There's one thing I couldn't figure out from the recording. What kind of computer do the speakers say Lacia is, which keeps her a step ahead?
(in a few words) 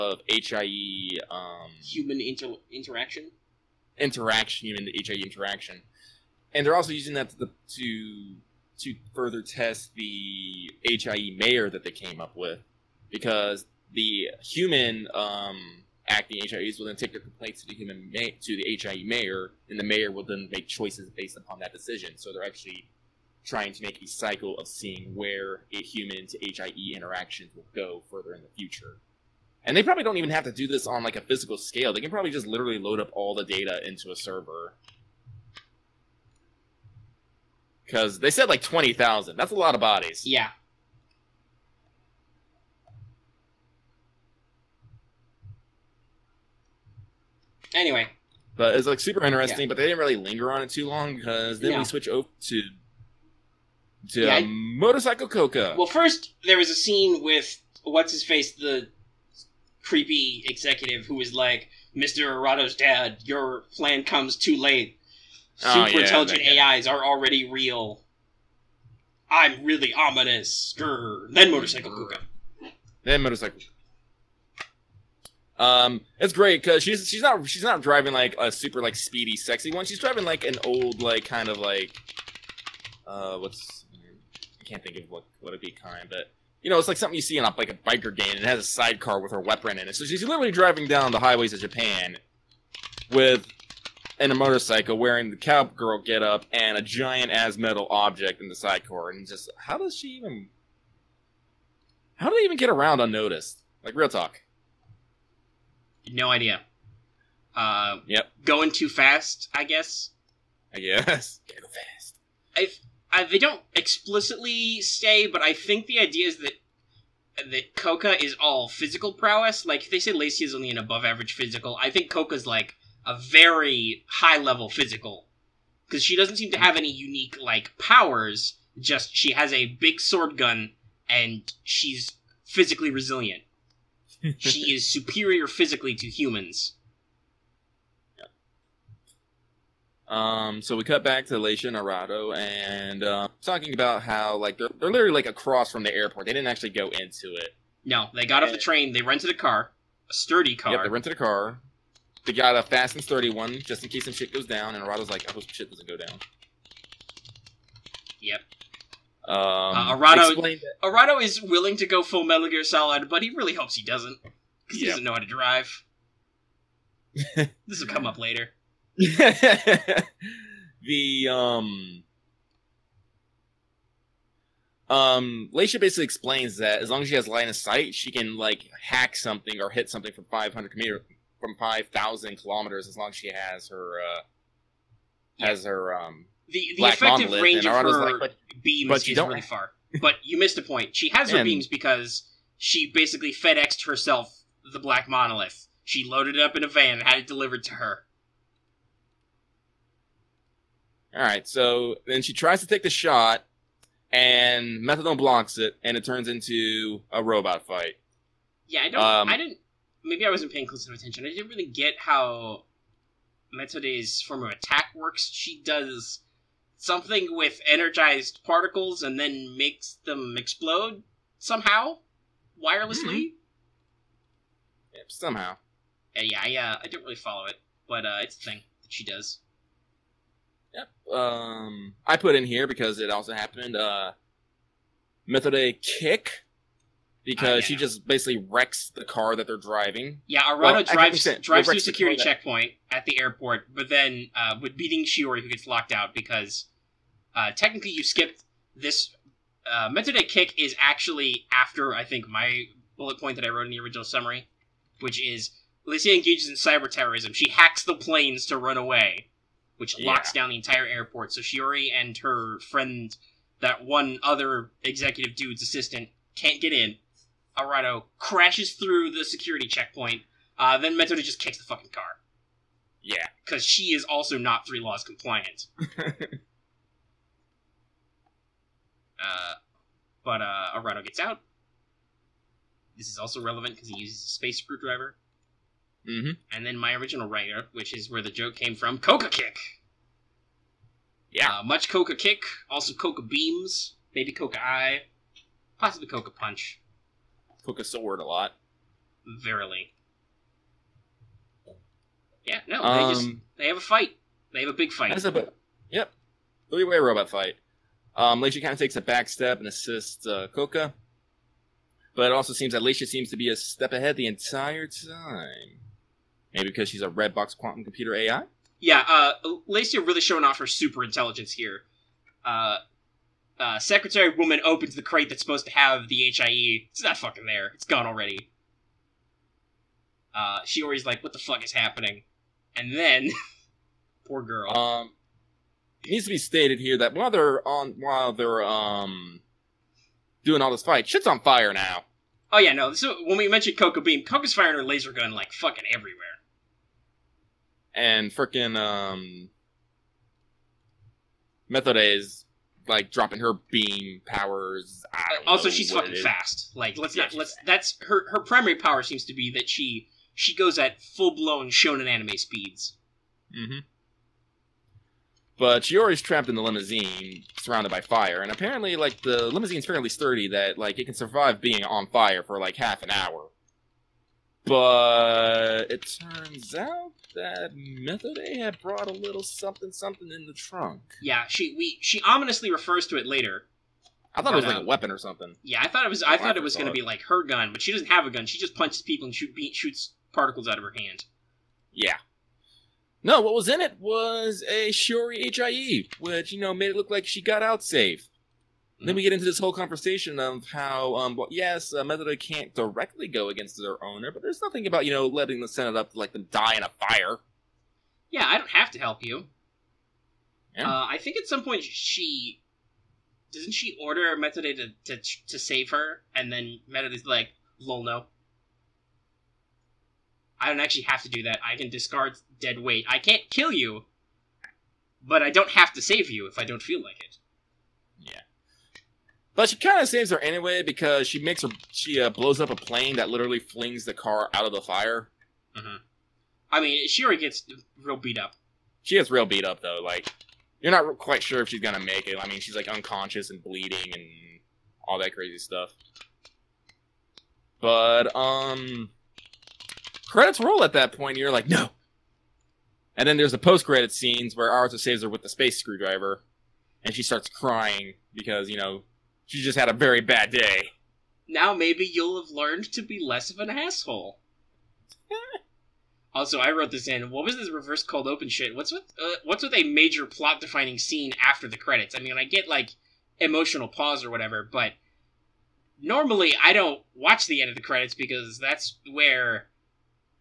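Red box quantum computer.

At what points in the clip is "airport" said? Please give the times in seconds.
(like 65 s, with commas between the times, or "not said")
145 s, 243 s, 260 s.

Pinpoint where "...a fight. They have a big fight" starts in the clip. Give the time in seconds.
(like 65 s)
303 s.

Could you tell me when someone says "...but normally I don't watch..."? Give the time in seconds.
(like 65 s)
474 s.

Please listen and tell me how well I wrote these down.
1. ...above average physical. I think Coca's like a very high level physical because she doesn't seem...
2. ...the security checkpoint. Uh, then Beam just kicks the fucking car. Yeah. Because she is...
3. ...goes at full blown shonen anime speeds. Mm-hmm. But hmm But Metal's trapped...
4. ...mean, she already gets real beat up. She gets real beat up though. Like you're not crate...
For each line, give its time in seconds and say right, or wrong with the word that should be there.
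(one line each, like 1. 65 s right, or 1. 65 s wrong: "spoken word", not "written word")
1. 120 s right
2. 269 s wrong: "Metoda", not "Beam"
3. 360 s wrong: "Shiori", not "Metal"
4. 436 s wrong: "quite", not "crate".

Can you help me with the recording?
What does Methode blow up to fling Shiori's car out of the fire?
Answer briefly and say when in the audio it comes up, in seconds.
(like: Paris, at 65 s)
A plane, at 432 s.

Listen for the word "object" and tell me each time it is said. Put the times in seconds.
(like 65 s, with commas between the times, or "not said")
97 s.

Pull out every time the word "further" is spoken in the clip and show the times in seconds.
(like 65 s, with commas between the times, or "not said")
9 s, 28 s.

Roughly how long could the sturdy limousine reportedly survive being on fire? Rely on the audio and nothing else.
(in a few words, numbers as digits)
Half an hour.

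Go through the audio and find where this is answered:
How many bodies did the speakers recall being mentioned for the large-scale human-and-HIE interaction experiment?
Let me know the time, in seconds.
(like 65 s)
38 s.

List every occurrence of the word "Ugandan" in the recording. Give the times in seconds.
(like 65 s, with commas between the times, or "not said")
not said.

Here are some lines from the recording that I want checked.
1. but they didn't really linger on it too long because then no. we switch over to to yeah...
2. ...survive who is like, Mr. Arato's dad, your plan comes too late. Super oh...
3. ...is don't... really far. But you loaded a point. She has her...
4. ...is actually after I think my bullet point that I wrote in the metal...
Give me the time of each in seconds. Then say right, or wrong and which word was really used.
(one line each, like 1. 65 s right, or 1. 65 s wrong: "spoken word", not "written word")
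1. 49 s right
2. 60 s wrong: "executive", not "survive"
3. 189 s wrong: "missed", not "loaded"
4. 250 s wrong: "original", not "metal".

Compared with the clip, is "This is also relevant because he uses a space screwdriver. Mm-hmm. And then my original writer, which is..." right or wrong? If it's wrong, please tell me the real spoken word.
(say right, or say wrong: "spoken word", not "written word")
right.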